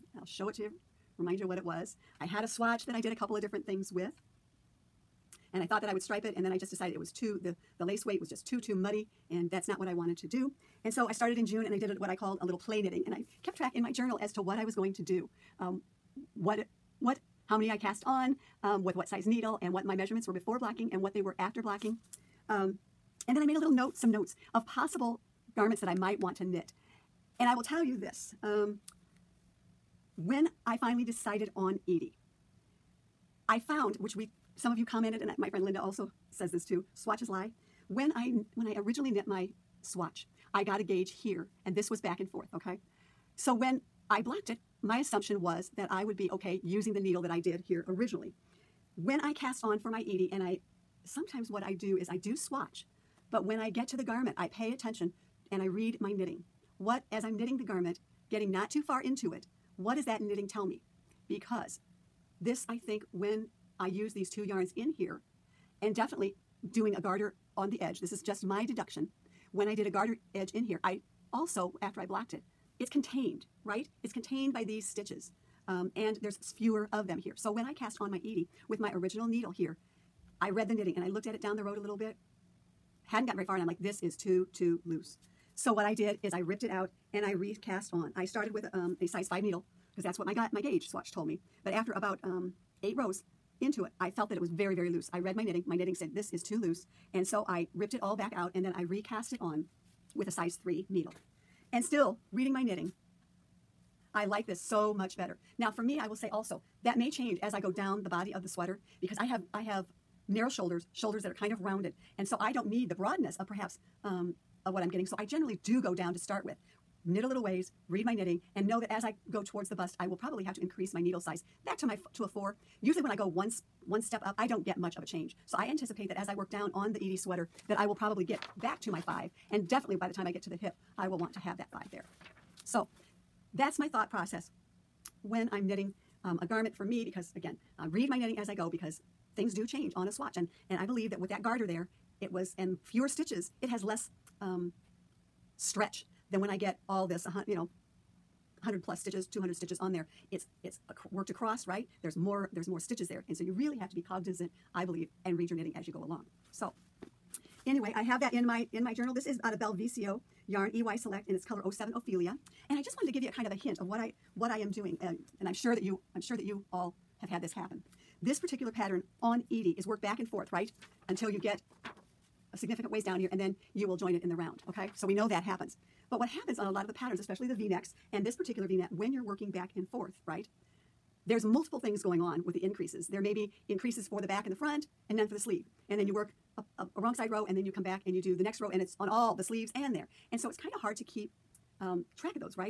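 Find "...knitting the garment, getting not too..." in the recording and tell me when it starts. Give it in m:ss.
0:57.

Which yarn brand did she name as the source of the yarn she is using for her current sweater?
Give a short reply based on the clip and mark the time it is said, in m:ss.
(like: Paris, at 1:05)
Belvicio, at 2:39.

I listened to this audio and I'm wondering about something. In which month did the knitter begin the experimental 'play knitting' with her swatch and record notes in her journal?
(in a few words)
June.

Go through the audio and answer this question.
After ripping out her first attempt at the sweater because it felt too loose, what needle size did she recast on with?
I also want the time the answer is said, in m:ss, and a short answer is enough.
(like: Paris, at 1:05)
3, at 1:40.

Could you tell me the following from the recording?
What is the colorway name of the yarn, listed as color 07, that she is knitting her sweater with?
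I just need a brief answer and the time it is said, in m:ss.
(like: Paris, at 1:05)
Ophelia, at 2:41.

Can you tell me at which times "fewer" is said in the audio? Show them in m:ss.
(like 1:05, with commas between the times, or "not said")
1:16, 2:22.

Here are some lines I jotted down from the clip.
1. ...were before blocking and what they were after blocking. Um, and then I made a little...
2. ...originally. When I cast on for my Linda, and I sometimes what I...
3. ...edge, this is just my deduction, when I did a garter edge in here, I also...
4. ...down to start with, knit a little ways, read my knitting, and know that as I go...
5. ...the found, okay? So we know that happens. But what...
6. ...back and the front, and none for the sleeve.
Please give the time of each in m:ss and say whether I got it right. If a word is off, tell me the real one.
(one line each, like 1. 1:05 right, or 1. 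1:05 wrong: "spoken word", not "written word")
1. 0:20 right
2. 0:47 wrong: "Edie", not "Linda"
3. 1:07 right
4. 1:55 right
5. 2:54 wrong: "round", not "found"
6. 3:04 right.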